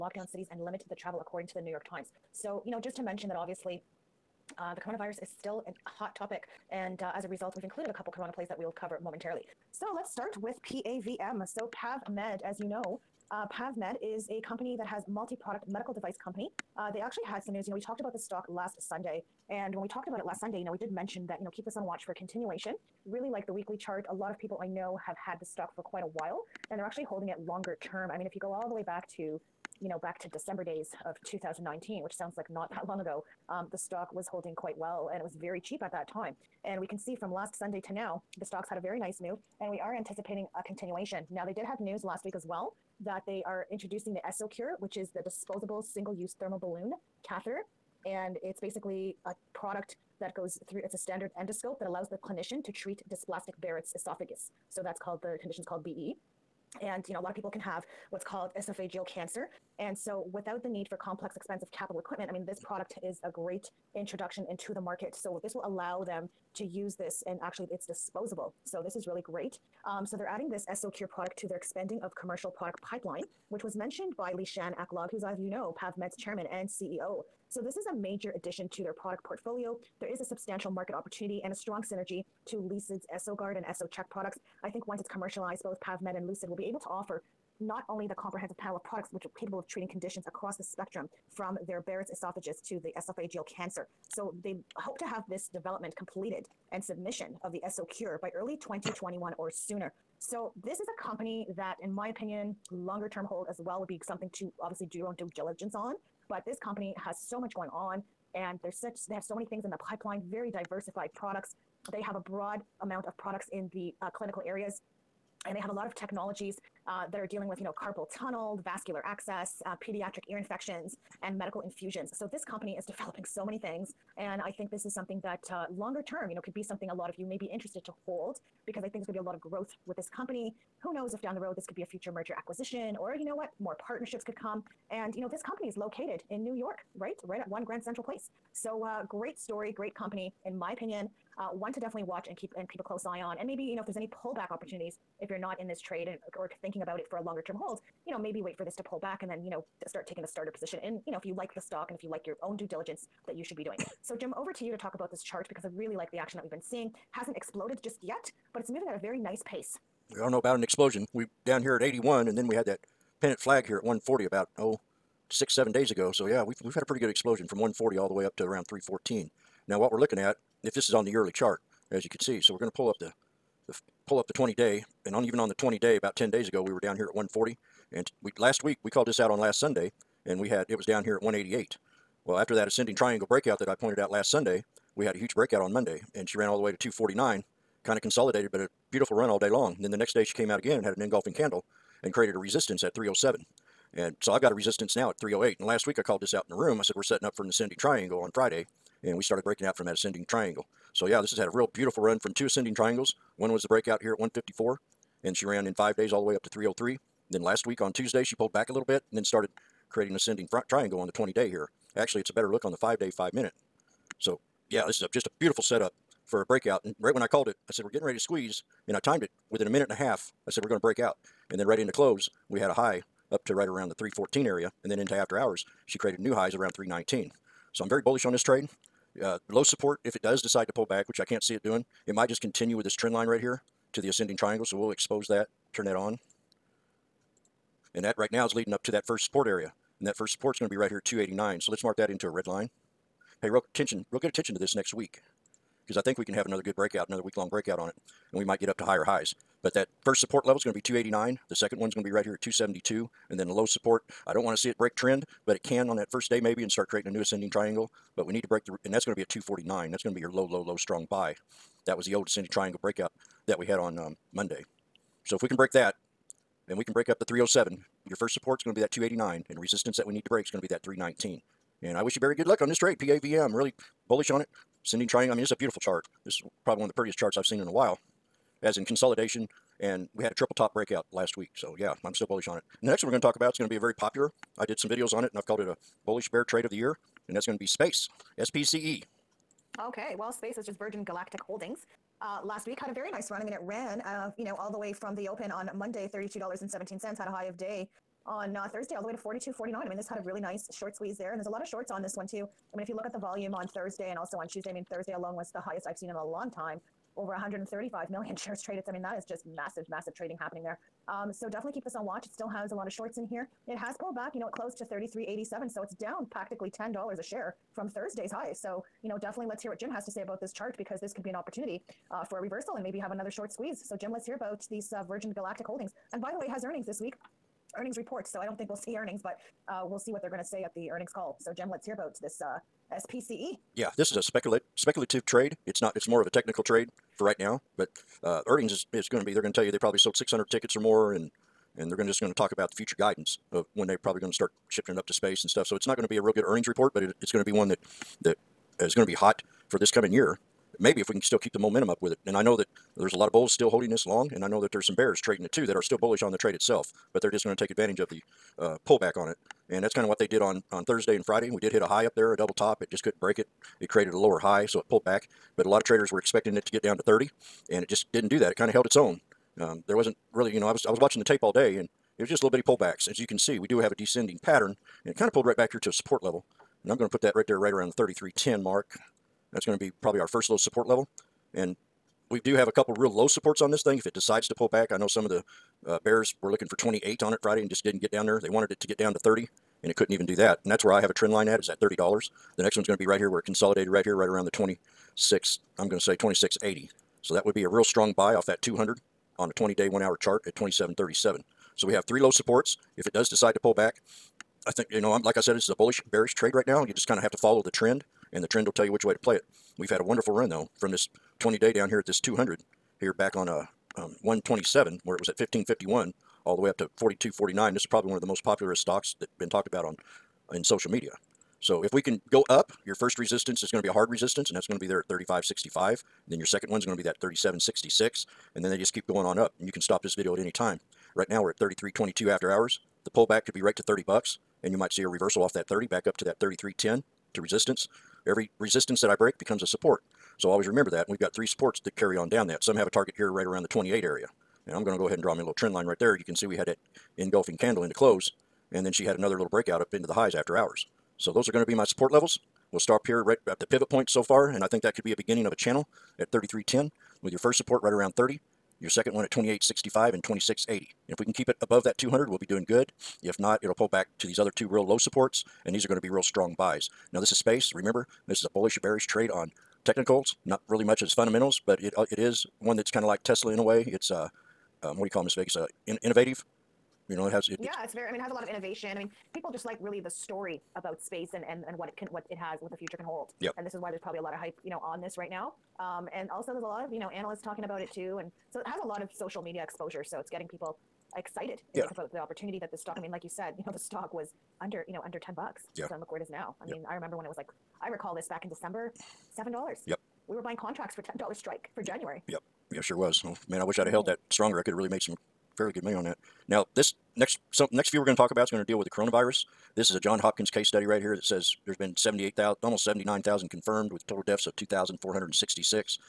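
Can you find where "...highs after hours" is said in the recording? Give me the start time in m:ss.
7:30.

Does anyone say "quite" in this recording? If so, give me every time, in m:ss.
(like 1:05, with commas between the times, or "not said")
0:25, 0:34.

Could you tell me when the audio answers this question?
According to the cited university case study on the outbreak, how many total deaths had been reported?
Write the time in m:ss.
8:34.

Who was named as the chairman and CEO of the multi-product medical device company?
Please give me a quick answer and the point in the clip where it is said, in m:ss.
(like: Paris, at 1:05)
Shan Aklog, at 1:14.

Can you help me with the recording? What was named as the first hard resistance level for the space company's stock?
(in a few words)
35.65.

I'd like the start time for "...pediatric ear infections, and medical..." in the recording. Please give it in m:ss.
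1:59.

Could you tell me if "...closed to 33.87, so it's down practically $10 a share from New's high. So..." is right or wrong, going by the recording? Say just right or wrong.
wrong.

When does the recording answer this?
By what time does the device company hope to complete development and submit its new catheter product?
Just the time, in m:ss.
1:38.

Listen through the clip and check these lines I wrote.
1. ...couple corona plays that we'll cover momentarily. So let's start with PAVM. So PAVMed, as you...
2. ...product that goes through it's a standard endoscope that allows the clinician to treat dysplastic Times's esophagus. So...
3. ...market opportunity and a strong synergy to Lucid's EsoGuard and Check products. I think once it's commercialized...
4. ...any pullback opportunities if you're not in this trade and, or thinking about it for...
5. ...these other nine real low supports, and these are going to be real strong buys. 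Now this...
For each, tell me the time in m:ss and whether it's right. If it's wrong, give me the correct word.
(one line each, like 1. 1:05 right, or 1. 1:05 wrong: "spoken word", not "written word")
1. 0:07 right
2. 0:49 wrong: "Barrett", not "Times"
3. 1:20 right
4. 2:23 right
5. 7:44 wrong: "two", not "nine".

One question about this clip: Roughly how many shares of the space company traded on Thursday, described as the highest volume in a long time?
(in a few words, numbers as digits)
135 million.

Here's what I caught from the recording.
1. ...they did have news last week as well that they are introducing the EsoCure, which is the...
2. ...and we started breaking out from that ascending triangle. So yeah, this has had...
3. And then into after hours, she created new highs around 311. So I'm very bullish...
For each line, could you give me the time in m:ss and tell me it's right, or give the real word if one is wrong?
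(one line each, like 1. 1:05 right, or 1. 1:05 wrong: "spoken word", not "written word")
1. 0:41 right
2. 3:19 right
3. 3:44 wrong: "319", not "311".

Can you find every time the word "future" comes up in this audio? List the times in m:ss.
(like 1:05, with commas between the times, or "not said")
2:11, 5:42, 8:02.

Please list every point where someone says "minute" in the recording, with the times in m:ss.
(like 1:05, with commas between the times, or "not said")
3:33, 3:39.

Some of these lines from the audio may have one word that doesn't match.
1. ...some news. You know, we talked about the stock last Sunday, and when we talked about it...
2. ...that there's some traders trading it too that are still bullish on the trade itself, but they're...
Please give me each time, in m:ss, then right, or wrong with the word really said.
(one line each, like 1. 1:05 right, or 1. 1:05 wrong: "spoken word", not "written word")
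1. 0:17 right
2. 5:54 wrong: "bears", not "traders".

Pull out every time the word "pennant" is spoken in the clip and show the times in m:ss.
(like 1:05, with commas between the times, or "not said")
2:43.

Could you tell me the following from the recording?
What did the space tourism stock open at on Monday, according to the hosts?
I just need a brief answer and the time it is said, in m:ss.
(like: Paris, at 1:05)
$32.17, at 4:56.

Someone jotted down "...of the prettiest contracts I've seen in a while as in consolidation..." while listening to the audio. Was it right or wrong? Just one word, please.
wrong.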